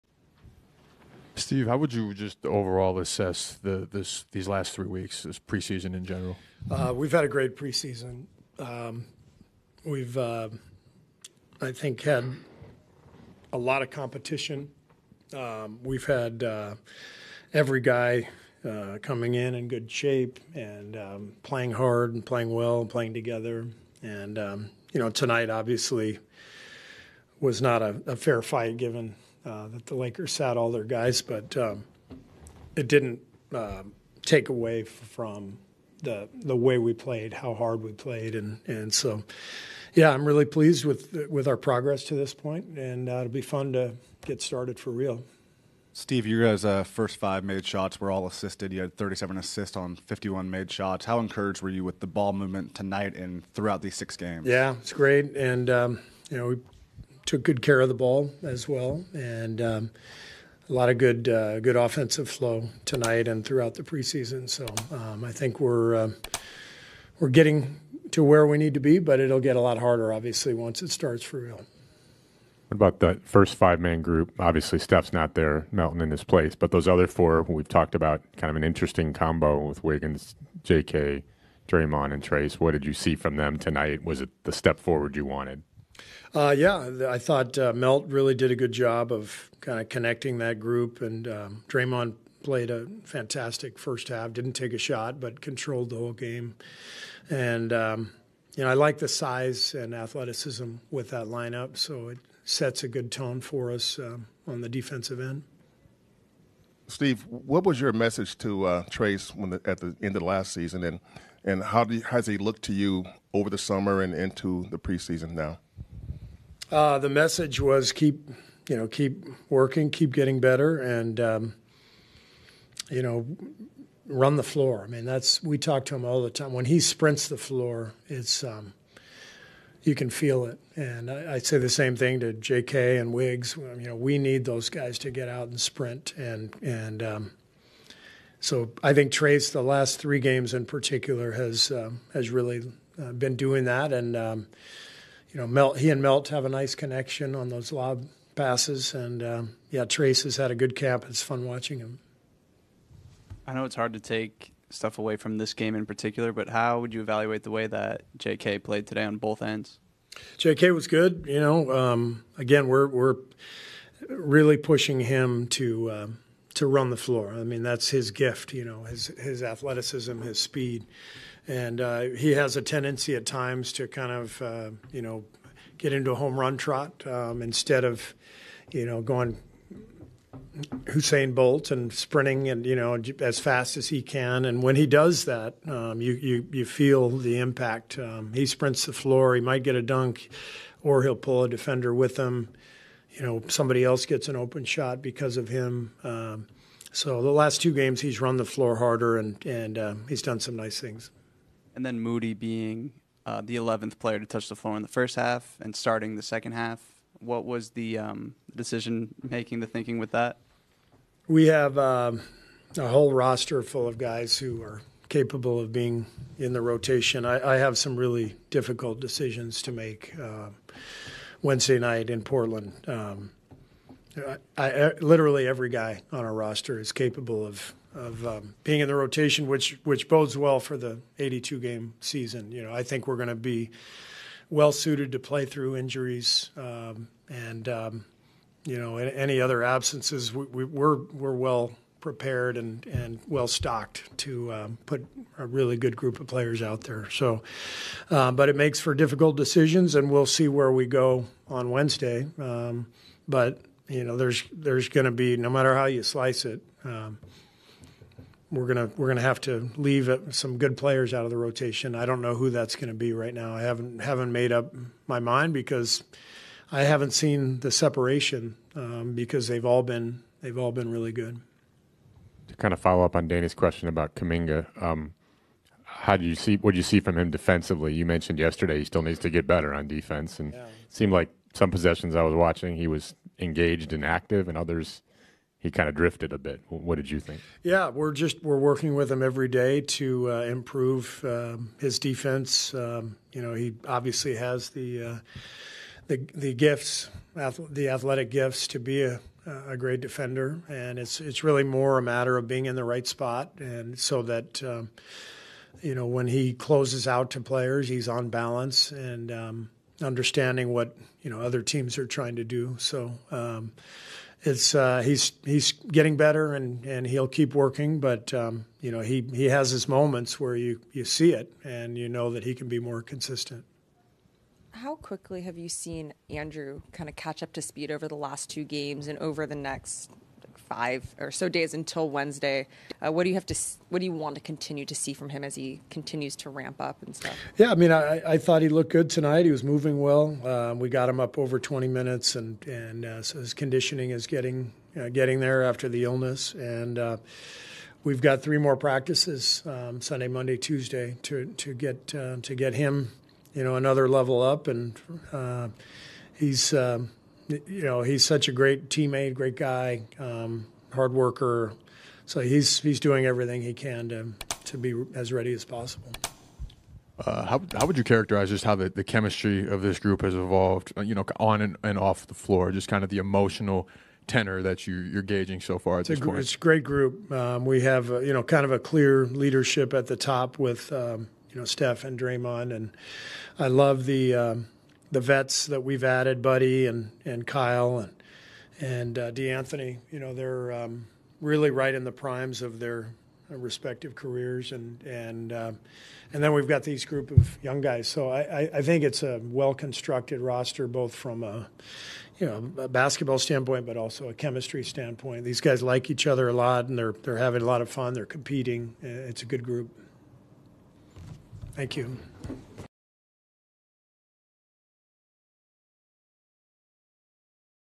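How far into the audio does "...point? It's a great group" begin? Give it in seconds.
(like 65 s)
376 s.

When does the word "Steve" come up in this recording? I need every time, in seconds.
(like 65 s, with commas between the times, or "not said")
1 s, 45 s, 106 s.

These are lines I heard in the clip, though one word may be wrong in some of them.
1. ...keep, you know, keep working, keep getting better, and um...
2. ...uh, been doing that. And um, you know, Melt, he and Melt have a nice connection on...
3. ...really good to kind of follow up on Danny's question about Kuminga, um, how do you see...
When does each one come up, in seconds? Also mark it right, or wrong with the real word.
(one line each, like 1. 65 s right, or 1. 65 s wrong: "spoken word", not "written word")
1. 117 s right
2. 143 s right
3. 270 s right.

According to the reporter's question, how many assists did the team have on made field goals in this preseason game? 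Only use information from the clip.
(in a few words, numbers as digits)
37.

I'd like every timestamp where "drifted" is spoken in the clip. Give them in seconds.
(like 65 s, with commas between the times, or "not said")
285 s.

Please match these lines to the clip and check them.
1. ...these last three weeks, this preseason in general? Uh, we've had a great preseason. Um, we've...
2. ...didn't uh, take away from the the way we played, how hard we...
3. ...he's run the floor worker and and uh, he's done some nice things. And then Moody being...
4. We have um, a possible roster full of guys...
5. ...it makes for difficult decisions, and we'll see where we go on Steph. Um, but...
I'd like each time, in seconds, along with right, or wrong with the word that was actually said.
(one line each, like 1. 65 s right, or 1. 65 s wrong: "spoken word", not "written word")
1. 4 s right
2. 32 s right
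3. 198 s wrong: "harder", not "worker"
4. 211 s wrong: "whole", not "possible"
5. 248 s wrong: "Wednesday", not "Steph".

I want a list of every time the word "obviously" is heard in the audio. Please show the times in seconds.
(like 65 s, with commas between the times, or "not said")
25 s, 70 s, 74 s, 293 s.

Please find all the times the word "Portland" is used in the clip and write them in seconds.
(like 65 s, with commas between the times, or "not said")
222 s.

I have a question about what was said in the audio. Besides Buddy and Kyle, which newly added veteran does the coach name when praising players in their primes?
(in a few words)
De'Anthony.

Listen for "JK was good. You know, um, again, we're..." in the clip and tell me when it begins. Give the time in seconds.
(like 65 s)
160 s.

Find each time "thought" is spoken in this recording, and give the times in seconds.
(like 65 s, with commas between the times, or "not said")
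87 s, 338 s.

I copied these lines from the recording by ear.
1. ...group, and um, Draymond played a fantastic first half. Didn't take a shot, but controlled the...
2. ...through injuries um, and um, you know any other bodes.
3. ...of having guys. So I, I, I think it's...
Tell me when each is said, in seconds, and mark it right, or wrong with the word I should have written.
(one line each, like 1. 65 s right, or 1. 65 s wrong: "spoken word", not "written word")
1. 90 s right
2. 235 s wrong: "absences", not "bodes"
3. 397 s wrong: "young", not "having".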